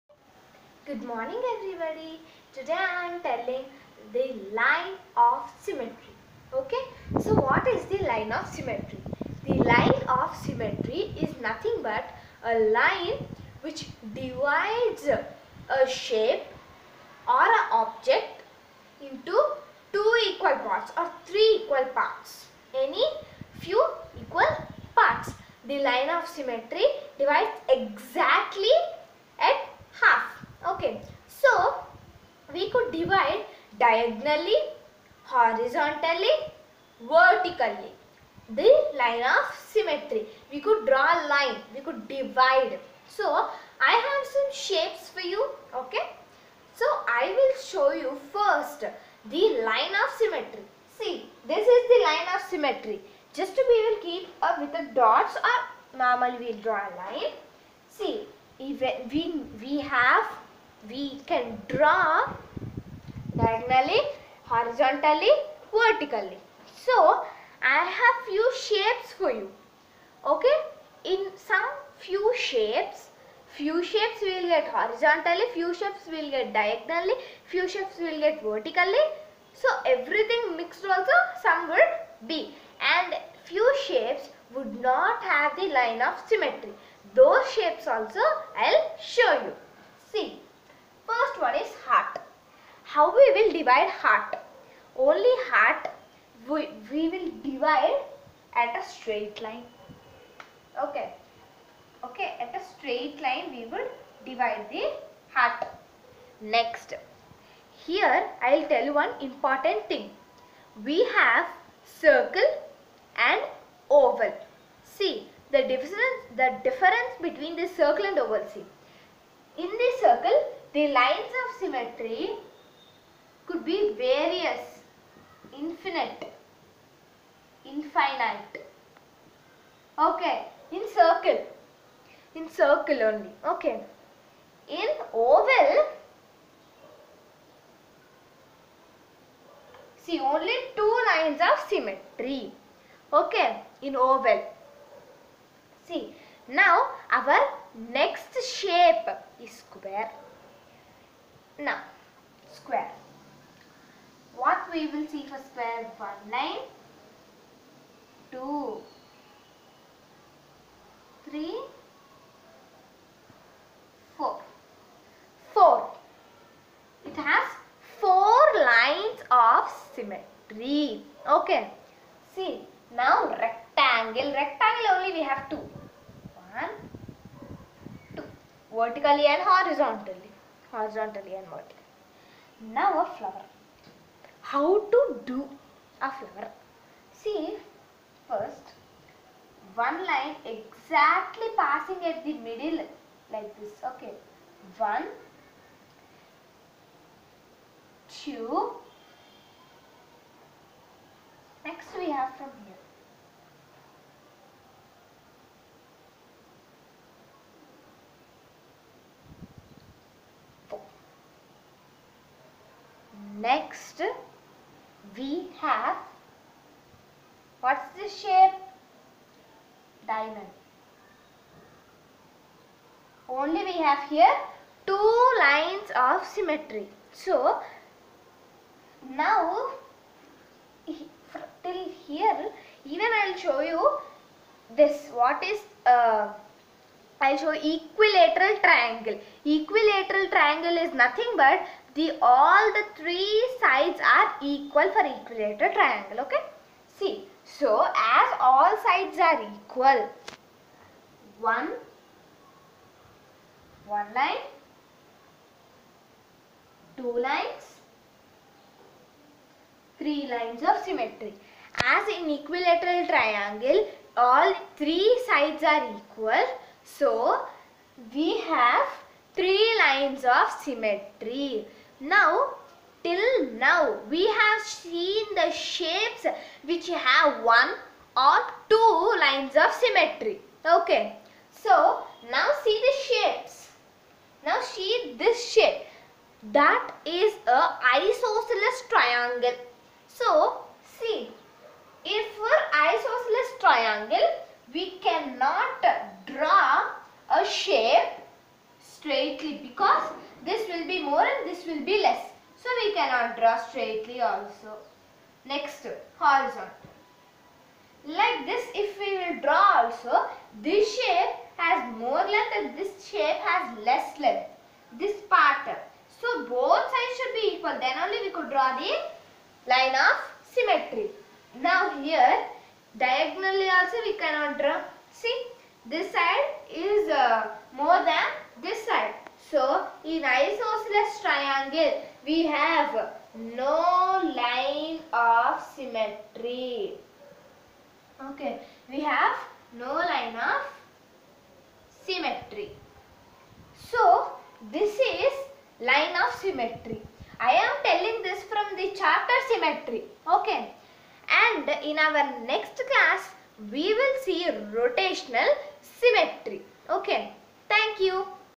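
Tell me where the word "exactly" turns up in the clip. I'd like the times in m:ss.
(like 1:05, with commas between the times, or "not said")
0:27, 3:10.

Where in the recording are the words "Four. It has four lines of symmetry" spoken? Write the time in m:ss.
2:45.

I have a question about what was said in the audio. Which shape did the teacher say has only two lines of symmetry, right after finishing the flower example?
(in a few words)
Diamond.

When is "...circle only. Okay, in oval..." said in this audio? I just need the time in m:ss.
2:12.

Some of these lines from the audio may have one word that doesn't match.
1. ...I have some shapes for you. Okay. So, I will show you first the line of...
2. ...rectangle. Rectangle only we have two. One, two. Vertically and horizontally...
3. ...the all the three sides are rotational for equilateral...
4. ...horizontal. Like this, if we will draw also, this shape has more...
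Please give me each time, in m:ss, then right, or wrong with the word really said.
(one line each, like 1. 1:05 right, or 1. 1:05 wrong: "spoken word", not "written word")
1. 0:43 right
2. 2:53 right
3. 4:01 wrong: "equal", not "rotational"
4. 5:06 right.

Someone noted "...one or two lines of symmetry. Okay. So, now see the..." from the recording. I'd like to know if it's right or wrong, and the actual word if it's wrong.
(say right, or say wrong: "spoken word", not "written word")
right.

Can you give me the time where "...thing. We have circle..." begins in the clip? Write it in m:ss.
1:49.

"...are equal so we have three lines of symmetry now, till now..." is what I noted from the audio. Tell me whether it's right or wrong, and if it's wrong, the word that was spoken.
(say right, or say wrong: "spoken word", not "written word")
right.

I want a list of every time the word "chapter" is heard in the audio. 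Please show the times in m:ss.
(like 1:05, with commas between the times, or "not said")
5:48.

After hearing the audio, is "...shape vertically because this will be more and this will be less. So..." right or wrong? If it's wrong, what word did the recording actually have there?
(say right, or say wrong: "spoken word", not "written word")
wrong: "straightly", not "vertically".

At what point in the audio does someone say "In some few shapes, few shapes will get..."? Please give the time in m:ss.
1:11.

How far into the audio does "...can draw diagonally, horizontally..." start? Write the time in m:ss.
1:01.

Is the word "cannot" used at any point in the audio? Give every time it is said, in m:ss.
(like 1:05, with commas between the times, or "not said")
4:55, 5:02, 5:24.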